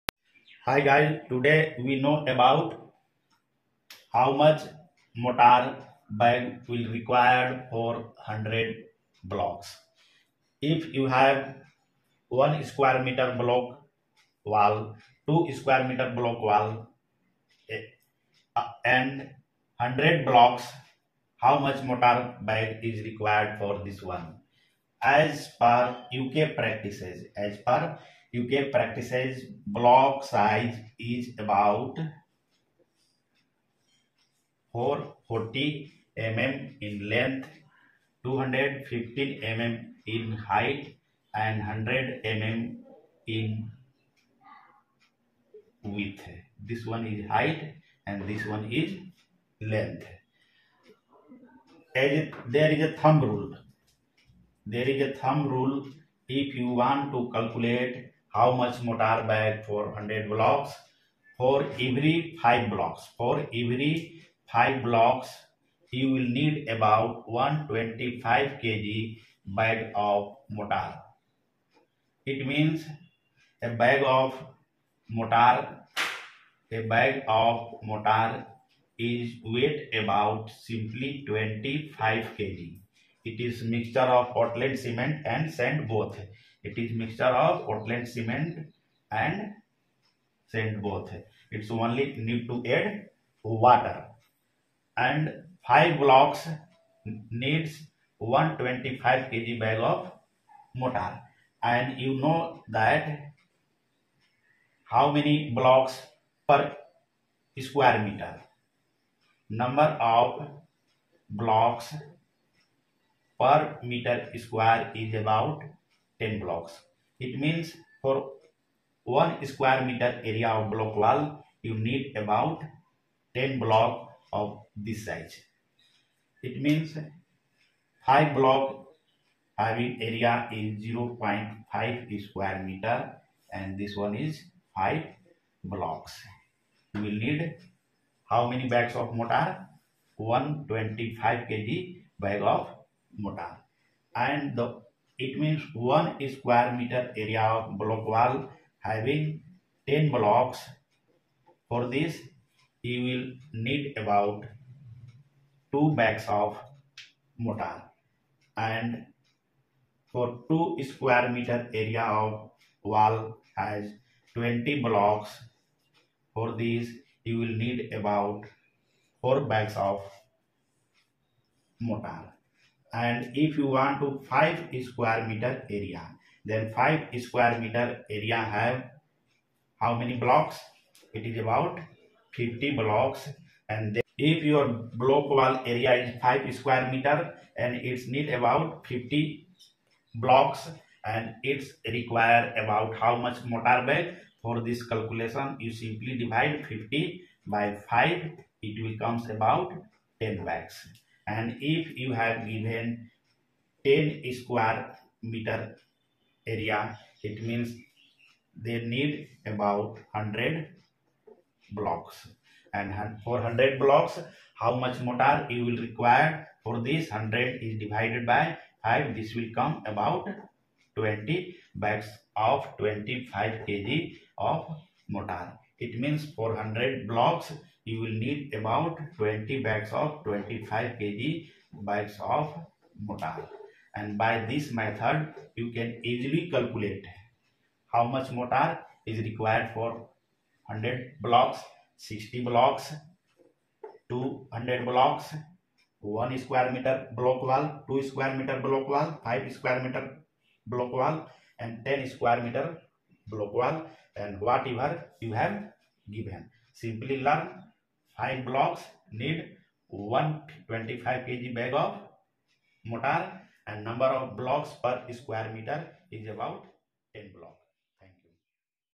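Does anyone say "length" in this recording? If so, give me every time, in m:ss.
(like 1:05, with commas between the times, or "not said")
0:37, 0:49.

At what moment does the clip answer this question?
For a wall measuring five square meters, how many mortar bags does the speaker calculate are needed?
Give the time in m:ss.
3:20.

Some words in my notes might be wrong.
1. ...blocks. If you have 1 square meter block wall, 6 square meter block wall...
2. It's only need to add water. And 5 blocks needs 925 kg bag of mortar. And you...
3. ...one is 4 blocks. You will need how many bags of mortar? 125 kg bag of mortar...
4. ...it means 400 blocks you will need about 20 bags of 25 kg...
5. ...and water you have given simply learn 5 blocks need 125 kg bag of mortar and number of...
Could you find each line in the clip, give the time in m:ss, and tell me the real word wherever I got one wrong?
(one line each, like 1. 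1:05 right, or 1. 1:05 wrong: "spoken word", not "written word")
1. 0:09 wrong: "2", not "6"
2. 1:31 wrong: "125", not "925"
3. 2:13 wrong: "5", not "4"
4. 3:45 right
5. 4:14 wrong: "whatever", not "water".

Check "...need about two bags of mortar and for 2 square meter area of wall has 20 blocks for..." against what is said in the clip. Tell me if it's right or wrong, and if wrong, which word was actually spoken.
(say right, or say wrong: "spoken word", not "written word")
right.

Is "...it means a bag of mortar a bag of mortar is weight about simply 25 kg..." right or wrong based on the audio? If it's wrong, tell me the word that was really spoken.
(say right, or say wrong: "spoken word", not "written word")
right.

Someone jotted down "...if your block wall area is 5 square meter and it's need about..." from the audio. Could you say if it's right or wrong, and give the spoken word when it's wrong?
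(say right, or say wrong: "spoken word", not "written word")
right.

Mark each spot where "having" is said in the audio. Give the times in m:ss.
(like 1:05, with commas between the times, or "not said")
2:09, 2:28.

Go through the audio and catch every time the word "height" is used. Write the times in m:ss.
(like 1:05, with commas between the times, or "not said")
0:40, 0:47.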